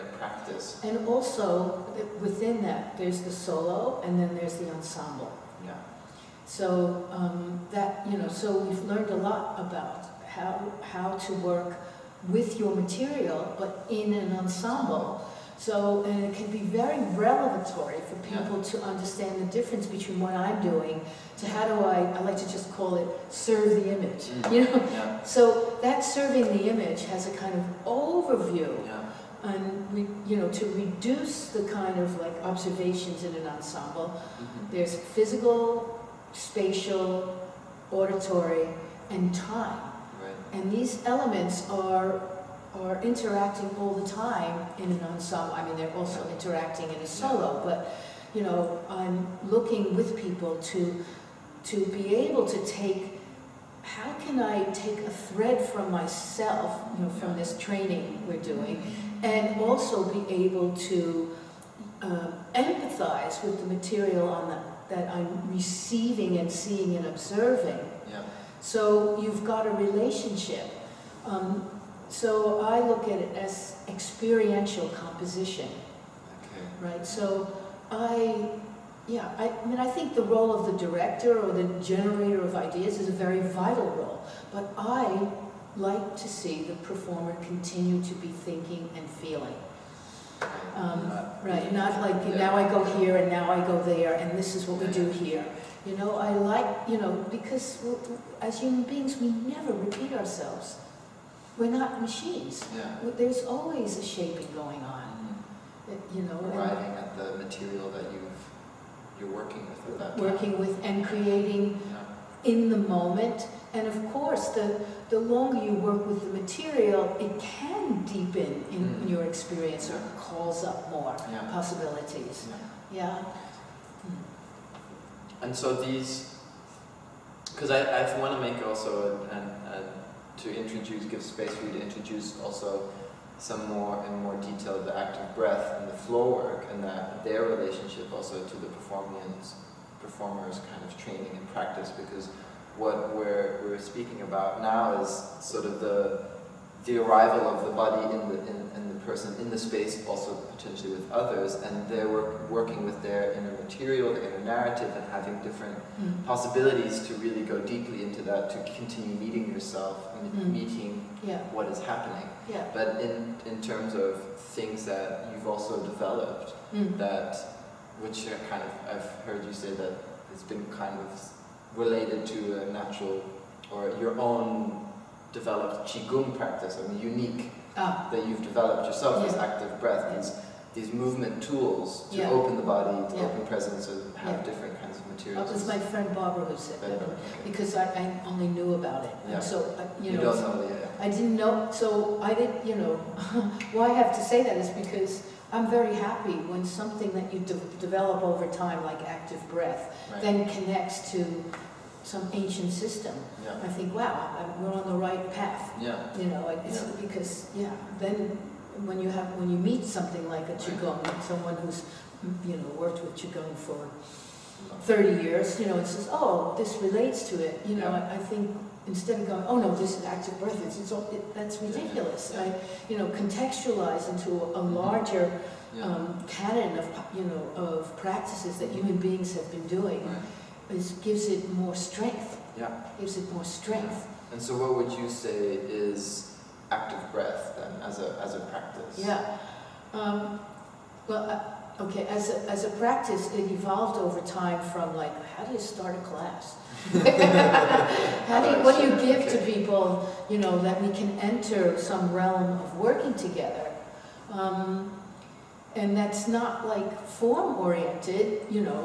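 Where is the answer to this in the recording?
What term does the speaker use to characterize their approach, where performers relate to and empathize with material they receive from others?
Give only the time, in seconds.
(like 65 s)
73 s.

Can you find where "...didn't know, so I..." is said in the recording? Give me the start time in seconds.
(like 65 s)
191 s.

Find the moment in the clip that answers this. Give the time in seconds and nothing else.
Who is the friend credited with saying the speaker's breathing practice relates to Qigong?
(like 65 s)
186 s.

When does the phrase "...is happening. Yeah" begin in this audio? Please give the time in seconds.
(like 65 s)
161 s.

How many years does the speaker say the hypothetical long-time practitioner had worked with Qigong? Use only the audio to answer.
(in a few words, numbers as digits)
30.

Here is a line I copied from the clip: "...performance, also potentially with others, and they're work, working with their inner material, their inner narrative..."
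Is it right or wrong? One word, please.
wrong.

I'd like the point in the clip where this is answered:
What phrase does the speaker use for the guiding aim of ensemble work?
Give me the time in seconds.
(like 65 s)
23 s.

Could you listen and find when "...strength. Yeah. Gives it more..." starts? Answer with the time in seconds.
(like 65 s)
231 s.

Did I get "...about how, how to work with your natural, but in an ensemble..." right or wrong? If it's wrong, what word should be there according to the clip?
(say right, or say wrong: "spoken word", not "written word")
wrong: "material", not "natural".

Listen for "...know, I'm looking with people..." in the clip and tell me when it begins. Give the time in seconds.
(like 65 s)
48 s.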